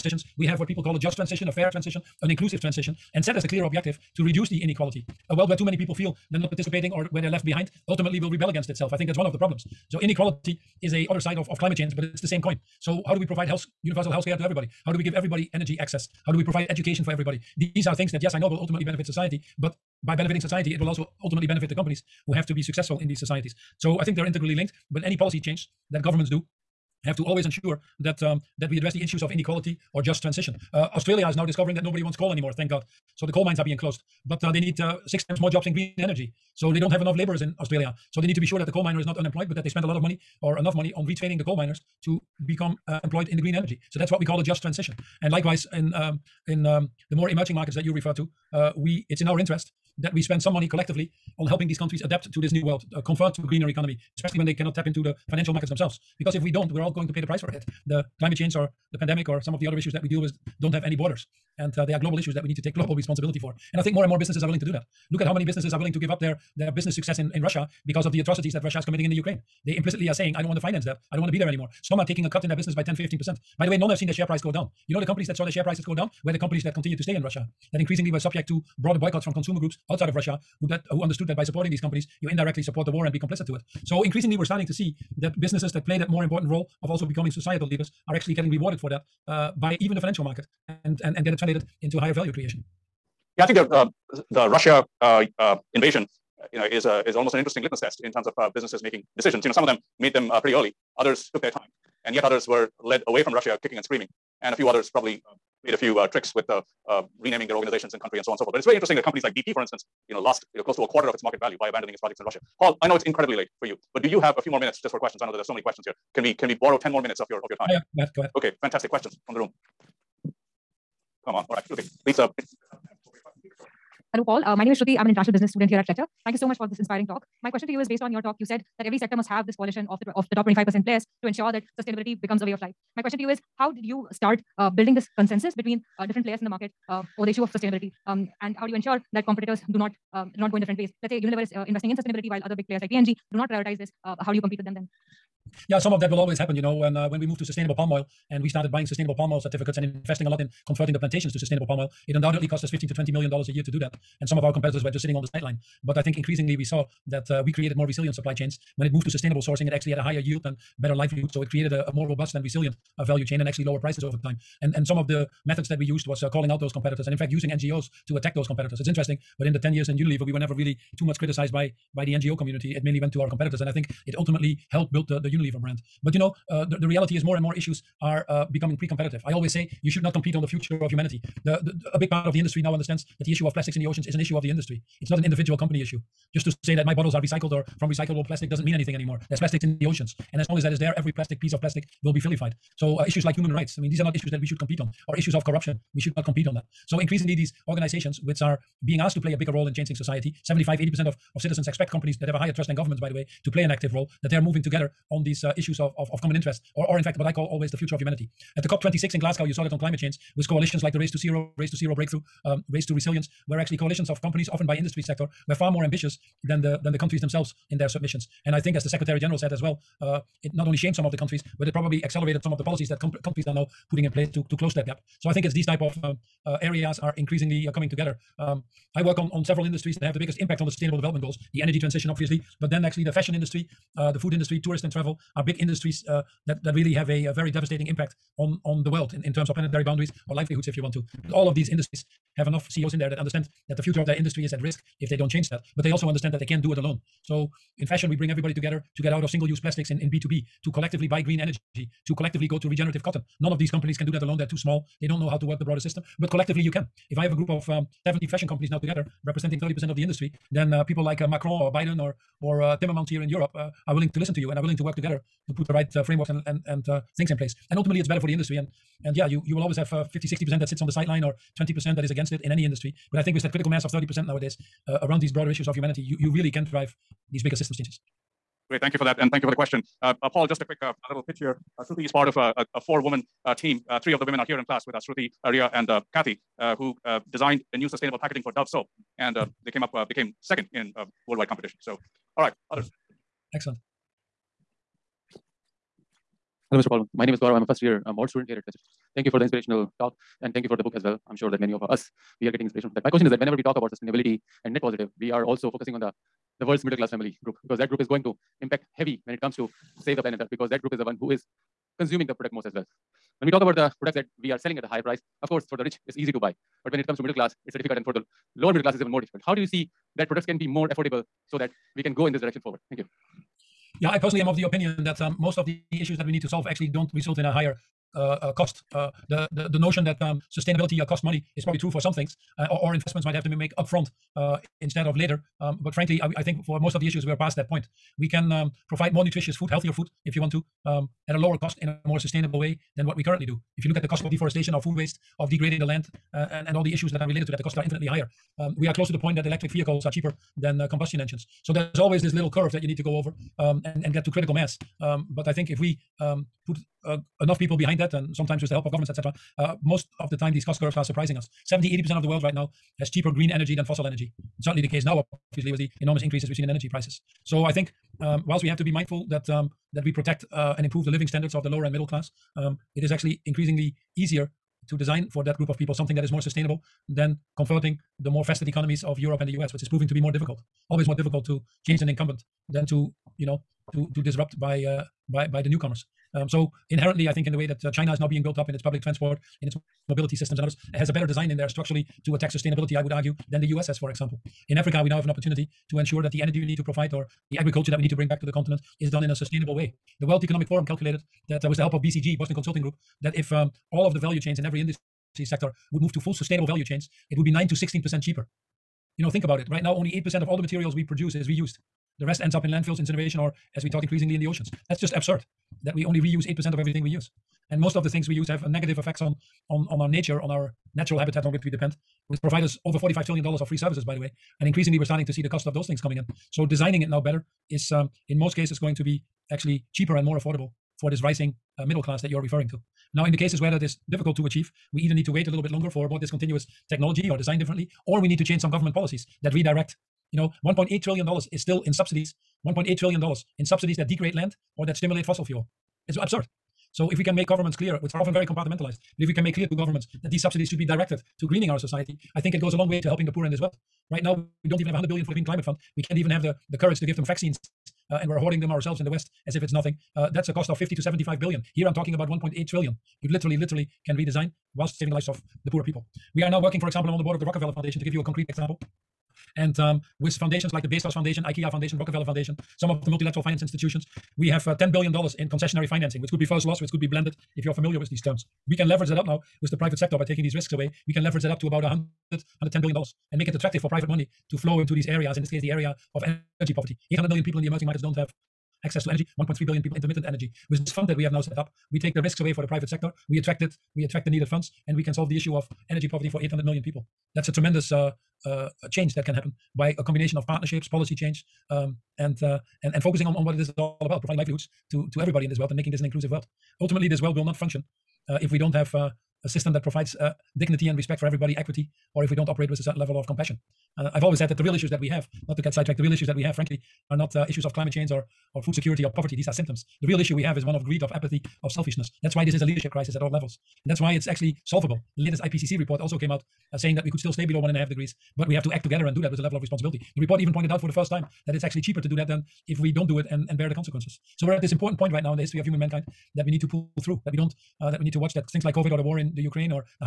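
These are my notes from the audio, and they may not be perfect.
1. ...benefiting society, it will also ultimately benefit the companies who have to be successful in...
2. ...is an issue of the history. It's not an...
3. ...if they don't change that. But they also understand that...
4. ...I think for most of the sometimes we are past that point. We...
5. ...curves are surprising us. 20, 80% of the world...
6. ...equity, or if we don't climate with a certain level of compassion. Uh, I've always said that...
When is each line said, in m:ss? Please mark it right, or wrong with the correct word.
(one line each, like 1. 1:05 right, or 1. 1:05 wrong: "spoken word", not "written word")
1. 0:20 right
2. 3:04 wrong: "industry", not "history"
3. 4:05 right
4. 5:36 wrong: "issues", not "sometimes"
5. 6:00 wrong: "70", not "20"
6. 8:31 wrong: "operate", not "climate".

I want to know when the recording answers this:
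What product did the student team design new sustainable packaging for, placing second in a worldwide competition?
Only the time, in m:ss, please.
4:48.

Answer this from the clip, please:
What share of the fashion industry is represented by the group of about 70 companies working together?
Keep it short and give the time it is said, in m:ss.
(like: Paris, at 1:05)
30%, at 4:19.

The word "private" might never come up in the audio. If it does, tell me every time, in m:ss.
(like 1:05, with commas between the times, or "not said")
7:59, 8:03, 8:12.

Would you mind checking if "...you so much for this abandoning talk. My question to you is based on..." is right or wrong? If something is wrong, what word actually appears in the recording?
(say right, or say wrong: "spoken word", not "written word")
wrong: "inspiring", not "abandoning".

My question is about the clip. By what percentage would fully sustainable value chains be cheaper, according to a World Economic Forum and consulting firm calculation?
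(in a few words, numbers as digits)
9 to 16%.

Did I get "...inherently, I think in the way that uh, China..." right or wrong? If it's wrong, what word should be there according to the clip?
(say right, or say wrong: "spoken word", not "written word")
right.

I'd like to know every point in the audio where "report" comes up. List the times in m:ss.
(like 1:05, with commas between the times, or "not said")
8:45, 8:50.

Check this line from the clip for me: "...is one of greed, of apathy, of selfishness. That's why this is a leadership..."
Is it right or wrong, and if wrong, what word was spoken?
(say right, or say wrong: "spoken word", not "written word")
right.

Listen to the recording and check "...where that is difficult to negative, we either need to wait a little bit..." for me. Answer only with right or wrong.
wrong.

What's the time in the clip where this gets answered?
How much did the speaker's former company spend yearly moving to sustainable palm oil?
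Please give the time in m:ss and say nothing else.
2:32.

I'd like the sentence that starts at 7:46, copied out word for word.
We are now working, for example, I'm on the board of the Rockefeller Foundation to give you a concrete example.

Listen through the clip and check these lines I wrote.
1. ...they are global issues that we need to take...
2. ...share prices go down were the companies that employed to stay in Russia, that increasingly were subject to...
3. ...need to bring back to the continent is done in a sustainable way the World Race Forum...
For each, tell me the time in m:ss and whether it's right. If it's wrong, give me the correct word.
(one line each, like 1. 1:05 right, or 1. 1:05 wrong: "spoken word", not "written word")
1. 1:01 right
2. 1:15 wrong: "continued", not "employed"
3. 6:38 wrong: "Economic", not "Race".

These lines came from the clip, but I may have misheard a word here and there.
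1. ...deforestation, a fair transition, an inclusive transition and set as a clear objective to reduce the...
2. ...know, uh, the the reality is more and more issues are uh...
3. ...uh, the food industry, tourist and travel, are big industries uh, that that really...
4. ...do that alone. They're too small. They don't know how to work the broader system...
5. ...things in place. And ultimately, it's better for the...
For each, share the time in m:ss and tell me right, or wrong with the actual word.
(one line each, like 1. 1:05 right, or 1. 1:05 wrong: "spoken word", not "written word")
1. 0:01 wrong: "transition", not "deforestation"
2. 2:56 right
3. 3:53 right
4. 4:14 right
5. 4:27 right.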